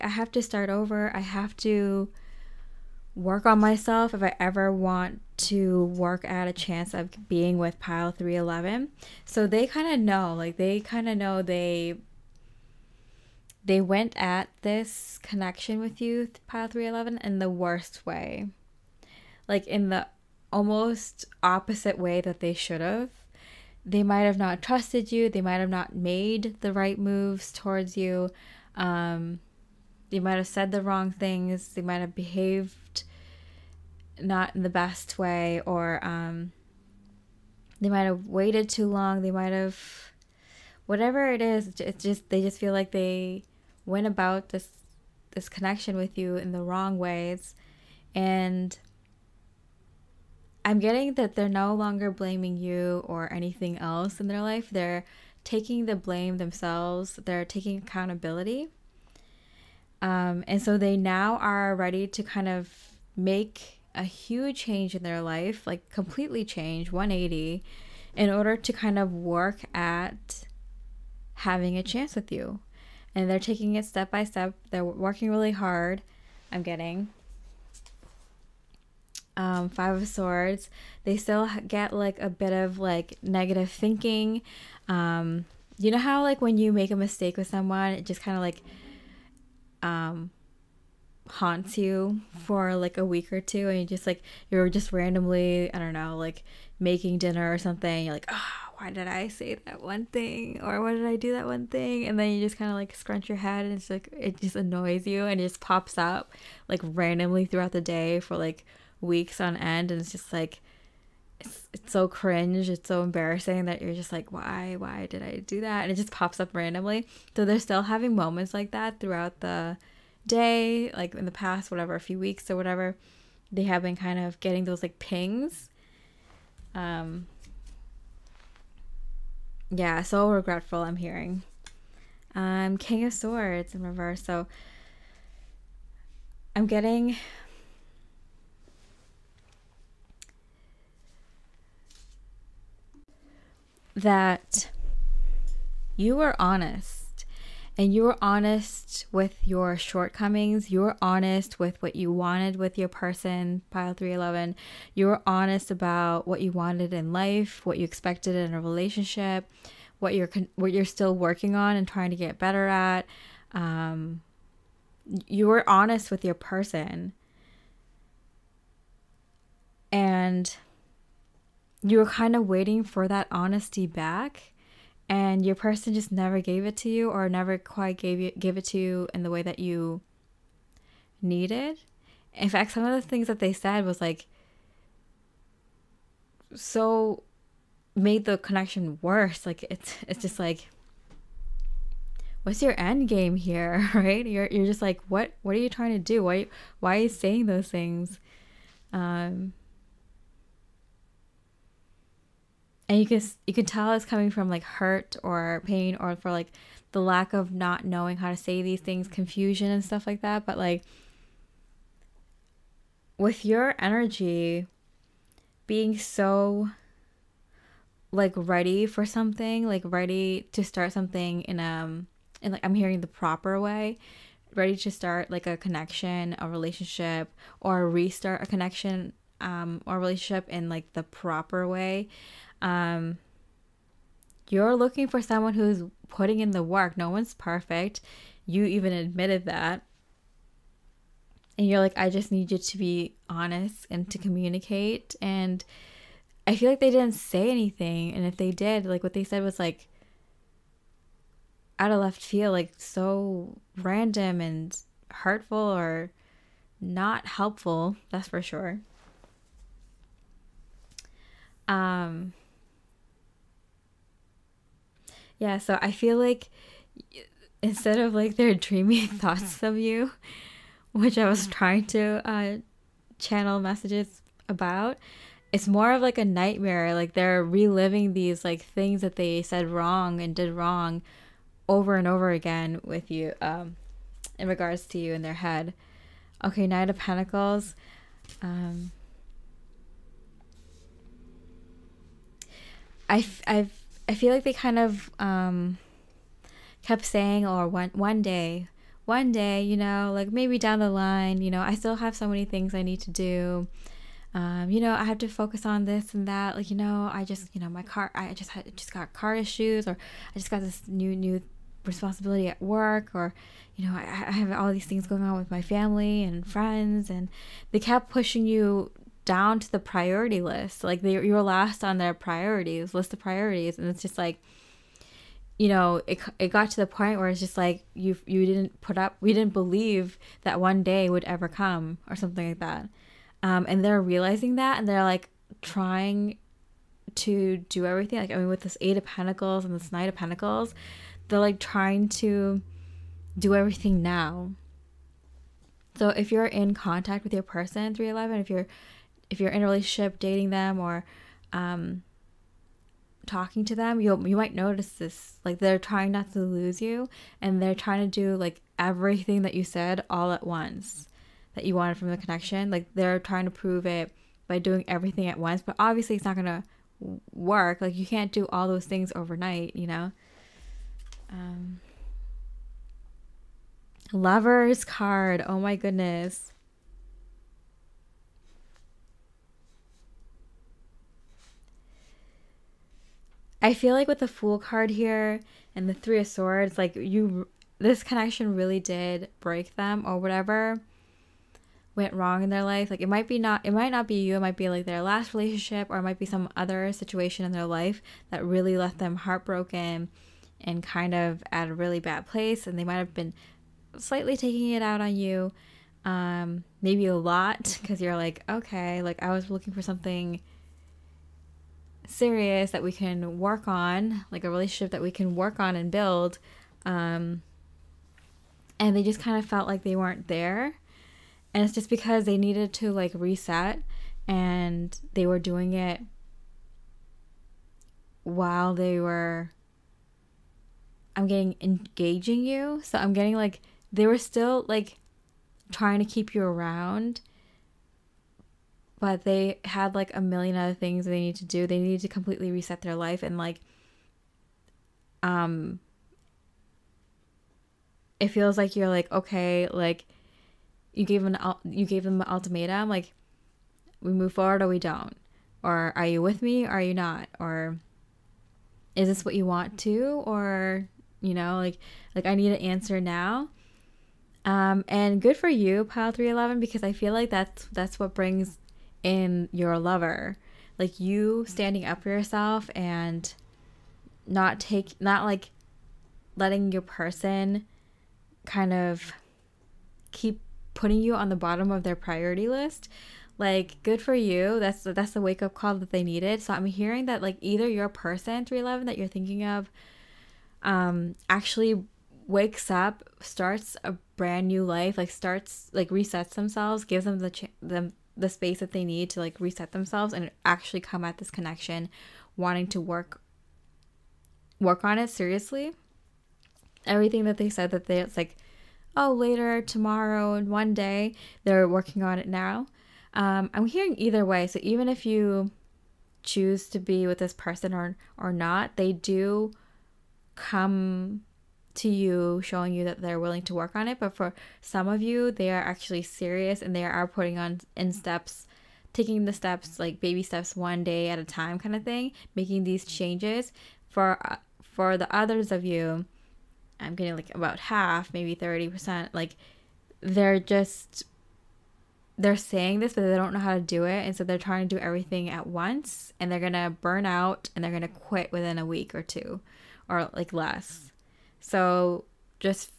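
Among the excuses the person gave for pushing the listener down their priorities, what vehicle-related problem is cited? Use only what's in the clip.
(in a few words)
car issues.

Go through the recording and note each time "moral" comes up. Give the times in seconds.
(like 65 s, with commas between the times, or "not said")
not said.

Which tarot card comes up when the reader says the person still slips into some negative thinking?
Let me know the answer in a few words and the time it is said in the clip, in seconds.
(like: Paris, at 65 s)
Five of Swords, at 79 s.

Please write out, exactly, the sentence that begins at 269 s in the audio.
of you which i was mm-hmm.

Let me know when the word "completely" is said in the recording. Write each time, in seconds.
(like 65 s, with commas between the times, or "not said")
65 s, 442 s.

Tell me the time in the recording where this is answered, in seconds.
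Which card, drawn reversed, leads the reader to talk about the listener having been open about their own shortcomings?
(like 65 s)
132 s.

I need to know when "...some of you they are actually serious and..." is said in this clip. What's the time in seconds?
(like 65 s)
524 s.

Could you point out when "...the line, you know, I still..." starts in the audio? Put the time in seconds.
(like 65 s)
300 s.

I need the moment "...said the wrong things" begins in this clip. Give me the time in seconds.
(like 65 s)
30 s.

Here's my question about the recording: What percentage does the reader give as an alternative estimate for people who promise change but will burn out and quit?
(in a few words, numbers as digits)
30%.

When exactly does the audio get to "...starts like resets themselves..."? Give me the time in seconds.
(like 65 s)
495 s.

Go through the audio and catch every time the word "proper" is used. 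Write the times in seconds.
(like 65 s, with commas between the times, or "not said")
223 s, 231 s.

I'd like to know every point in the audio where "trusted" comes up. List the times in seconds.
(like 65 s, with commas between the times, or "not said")
24 s.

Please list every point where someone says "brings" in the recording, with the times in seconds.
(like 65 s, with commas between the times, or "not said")
468 s.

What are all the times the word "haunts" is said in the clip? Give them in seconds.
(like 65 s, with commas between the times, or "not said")
91 s.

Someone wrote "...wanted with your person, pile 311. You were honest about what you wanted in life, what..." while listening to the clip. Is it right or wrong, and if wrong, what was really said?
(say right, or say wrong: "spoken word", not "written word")
right.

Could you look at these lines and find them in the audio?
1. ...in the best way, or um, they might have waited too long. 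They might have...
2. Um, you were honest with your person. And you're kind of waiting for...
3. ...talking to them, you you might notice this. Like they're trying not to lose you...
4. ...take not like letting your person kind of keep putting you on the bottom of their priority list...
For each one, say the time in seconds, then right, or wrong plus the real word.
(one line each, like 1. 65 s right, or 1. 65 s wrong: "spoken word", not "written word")
1. 34 s right
2. 163 s right
3. 353 s right
4. 474 s right.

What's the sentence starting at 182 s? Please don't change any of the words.
In fact, some of the things that they said was like so made the connection worse.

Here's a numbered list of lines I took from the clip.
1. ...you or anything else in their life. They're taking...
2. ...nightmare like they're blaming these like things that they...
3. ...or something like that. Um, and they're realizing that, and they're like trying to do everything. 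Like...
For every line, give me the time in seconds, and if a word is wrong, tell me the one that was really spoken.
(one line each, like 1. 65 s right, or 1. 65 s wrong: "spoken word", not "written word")
1. 52 s right
2. 276 s wrong: "reliving", not "blaming"
3. 332 s right.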